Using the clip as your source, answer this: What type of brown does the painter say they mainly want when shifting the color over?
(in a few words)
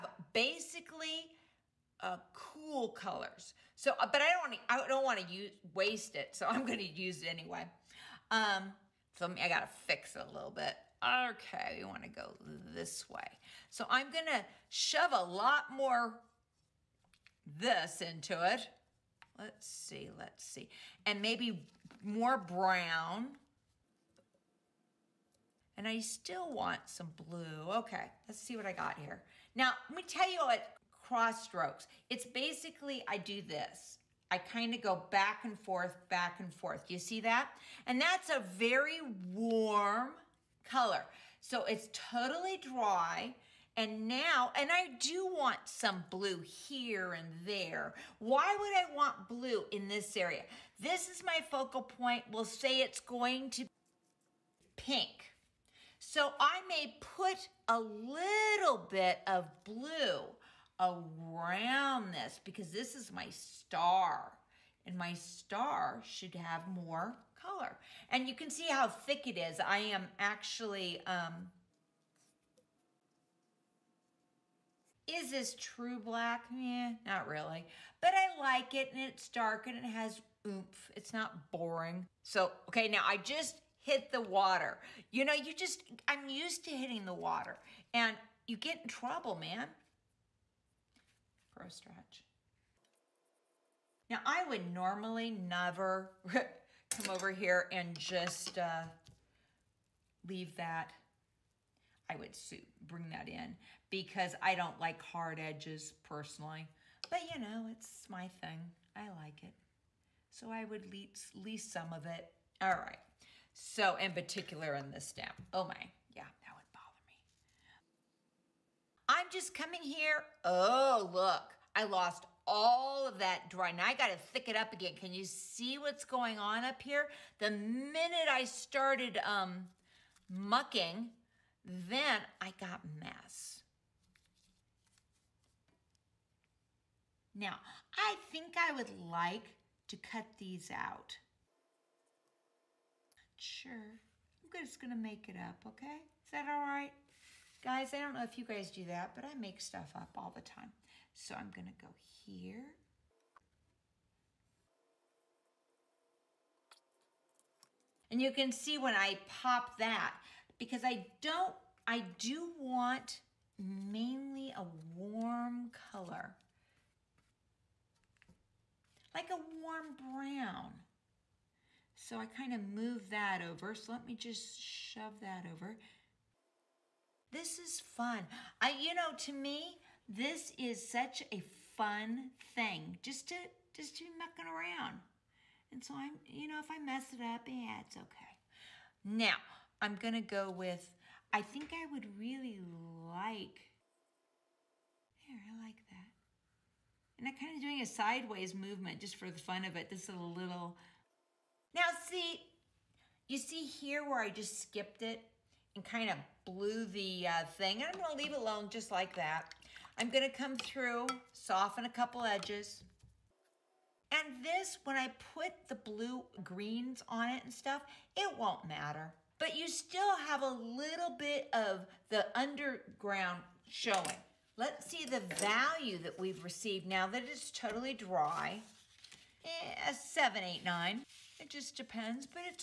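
warm brown.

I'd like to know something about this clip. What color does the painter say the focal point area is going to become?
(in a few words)
pink.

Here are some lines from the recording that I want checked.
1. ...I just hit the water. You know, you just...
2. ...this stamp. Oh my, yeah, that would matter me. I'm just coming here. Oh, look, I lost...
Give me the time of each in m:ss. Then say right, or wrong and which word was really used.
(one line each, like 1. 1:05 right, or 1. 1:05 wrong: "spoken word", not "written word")
1. 1:23 right
2. 1:54 wrong: "bother", not "matter".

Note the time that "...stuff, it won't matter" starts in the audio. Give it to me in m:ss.
3:37.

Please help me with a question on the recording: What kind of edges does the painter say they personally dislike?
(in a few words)
hard edges.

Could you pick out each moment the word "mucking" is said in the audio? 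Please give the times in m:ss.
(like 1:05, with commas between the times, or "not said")
2:10, 3:04.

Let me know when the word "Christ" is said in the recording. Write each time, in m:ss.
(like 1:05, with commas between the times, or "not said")
not said.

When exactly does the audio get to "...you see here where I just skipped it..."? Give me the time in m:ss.
3:23.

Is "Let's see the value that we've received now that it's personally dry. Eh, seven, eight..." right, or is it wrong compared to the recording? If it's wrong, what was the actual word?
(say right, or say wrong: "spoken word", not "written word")
wrong: "totally", not "personally".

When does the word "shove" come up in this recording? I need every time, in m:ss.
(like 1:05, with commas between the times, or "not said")
0:14, 2:54.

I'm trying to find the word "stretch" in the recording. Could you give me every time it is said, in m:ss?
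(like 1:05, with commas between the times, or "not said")
1:31.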